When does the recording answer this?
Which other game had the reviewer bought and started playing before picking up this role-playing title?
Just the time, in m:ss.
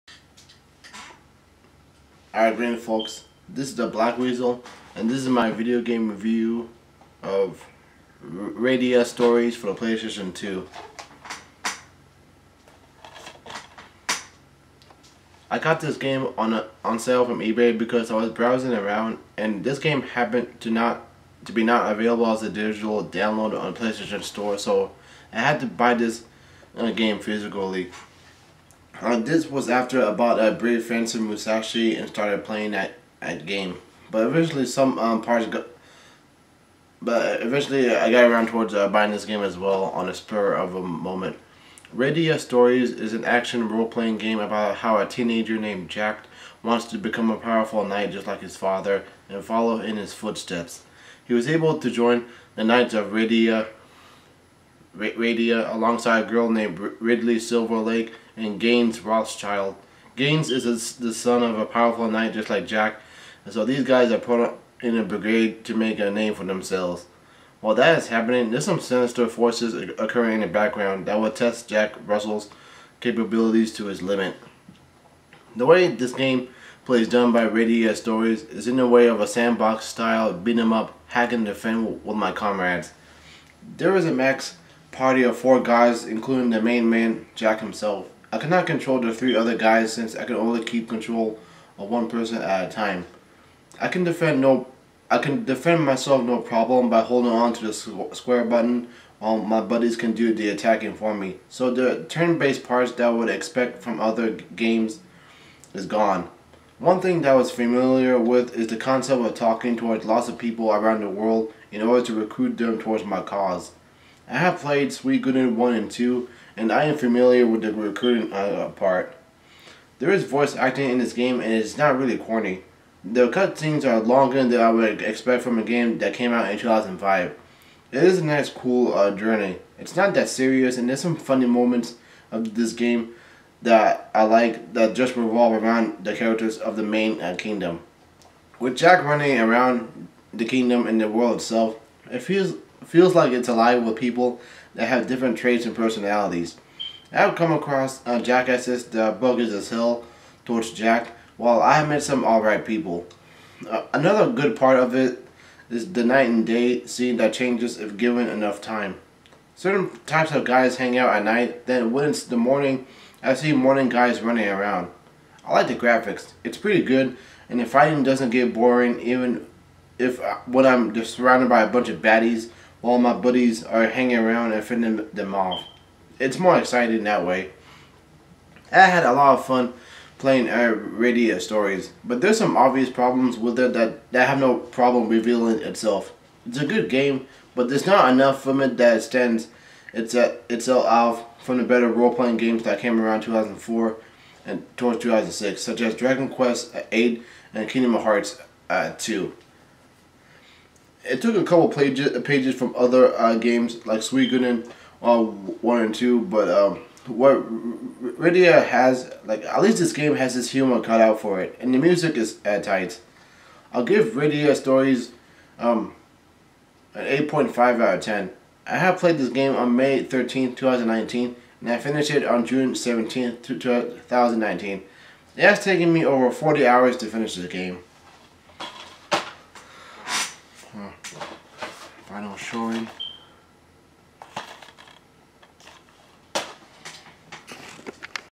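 0:30.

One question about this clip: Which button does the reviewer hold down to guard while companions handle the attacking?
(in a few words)
square.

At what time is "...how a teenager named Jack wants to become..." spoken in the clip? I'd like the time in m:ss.
0:44.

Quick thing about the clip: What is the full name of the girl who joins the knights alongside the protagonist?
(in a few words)
Ridley Silverlake.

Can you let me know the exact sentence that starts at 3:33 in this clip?
I'll give *Radiata* Stories um, an eight point five out of ten.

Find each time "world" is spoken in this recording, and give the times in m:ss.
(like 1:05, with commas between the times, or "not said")
1:51, 2:21.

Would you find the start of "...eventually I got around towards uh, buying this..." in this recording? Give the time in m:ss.
0:37.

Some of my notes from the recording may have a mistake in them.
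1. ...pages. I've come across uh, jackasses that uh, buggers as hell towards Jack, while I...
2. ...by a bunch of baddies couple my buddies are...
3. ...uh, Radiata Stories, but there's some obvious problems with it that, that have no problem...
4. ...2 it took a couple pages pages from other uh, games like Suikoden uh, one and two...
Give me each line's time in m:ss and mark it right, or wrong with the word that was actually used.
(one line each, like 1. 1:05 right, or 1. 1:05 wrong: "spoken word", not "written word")
1. 2:25 wrong: "personalities", not "pages"
2. 2:51 wrong: "while", not "couple"
3. 3:00 right
4. 3:18 right.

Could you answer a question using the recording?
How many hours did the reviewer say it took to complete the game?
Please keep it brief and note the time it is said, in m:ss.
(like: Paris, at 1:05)
over 40, at 3:46.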